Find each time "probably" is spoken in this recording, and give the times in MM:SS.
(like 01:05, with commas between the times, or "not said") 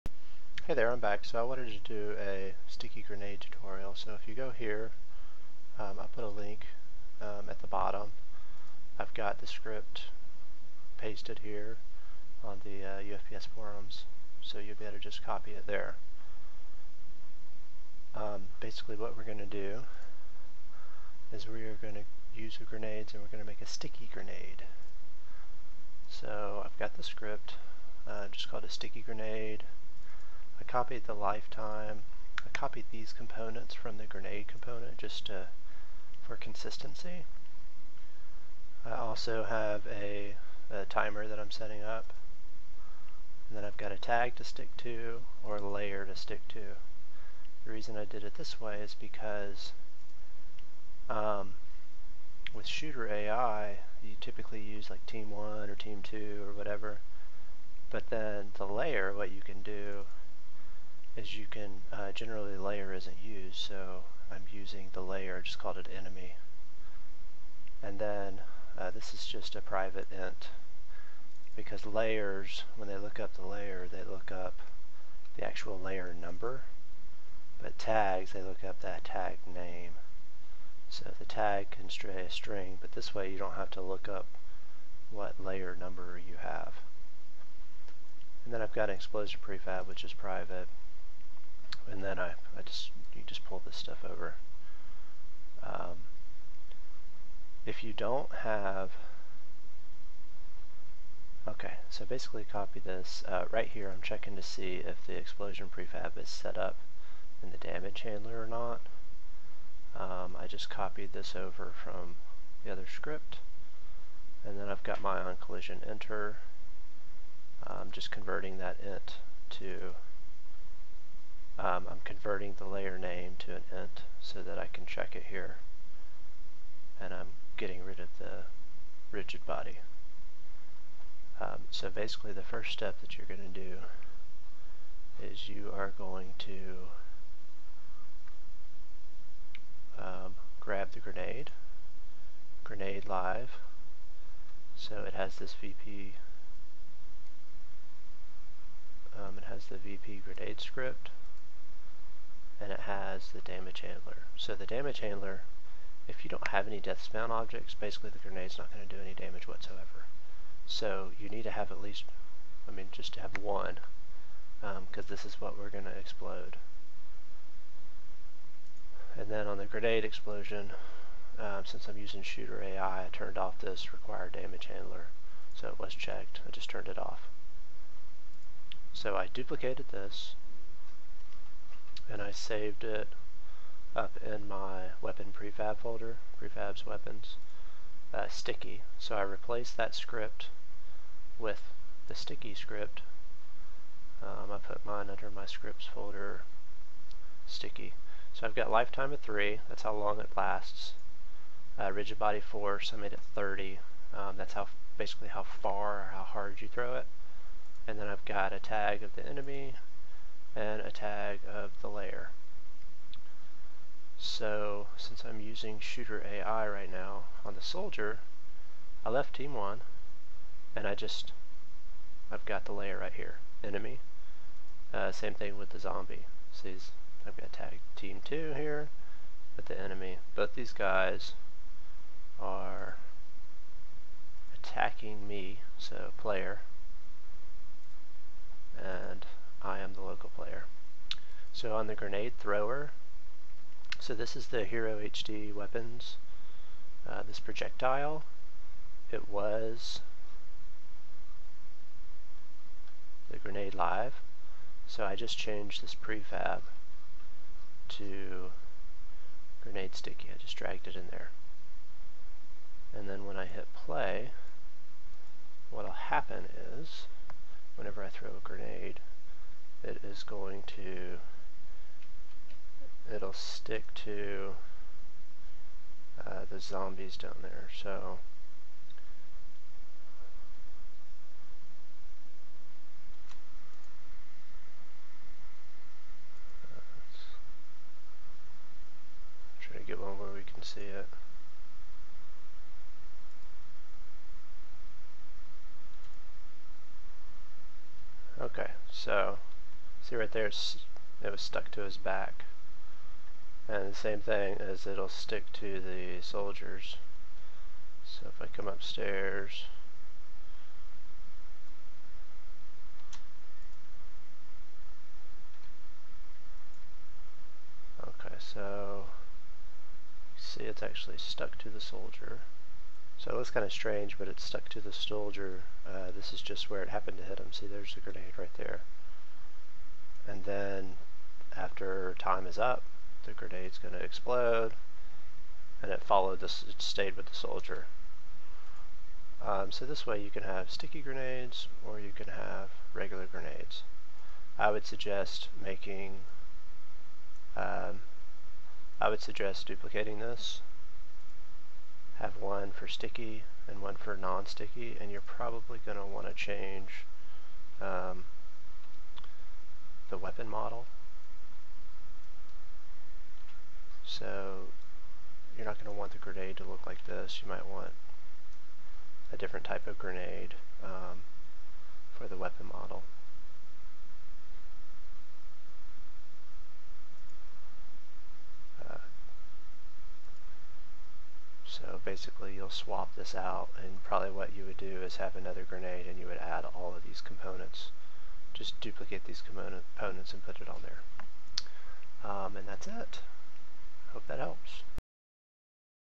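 05:55, 06:24.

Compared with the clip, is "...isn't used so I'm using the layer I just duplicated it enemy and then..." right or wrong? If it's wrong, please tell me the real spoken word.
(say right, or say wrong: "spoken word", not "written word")
wrong: "called", not "duplicated".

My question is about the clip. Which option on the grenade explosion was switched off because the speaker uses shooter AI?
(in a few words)
required damage handler.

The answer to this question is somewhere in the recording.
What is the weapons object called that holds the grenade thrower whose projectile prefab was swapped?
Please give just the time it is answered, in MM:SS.
04:04.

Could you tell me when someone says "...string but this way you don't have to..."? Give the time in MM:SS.
01:22.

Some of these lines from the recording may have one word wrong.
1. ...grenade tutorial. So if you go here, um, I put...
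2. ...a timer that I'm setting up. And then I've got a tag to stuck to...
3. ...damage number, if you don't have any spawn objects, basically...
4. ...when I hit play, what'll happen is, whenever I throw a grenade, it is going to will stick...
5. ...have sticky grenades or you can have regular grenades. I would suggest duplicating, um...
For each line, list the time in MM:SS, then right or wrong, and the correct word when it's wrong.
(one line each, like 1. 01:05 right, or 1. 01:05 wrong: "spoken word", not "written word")
1. 00:03 right
2. 00:40 wrong: "stick", not "stuck"
3. 02:34 wrong: "handler", not "number"
4. 04:23 right
5. 05:40 wrong: "making", not "duplicating".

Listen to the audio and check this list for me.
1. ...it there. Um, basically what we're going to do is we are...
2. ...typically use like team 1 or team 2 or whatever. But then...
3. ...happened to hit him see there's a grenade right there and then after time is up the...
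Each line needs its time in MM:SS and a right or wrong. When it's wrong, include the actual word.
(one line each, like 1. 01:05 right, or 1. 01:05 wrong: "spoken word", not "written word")
1. 00:15 right
2. 00:54 right
3. 05:26 right.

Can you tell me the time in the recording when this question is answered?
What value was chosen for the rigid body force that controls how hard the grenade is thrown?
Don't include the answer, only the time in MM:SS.
03:22.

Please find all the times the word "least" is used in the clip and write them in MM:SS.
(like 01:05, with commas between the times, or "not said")
02:41.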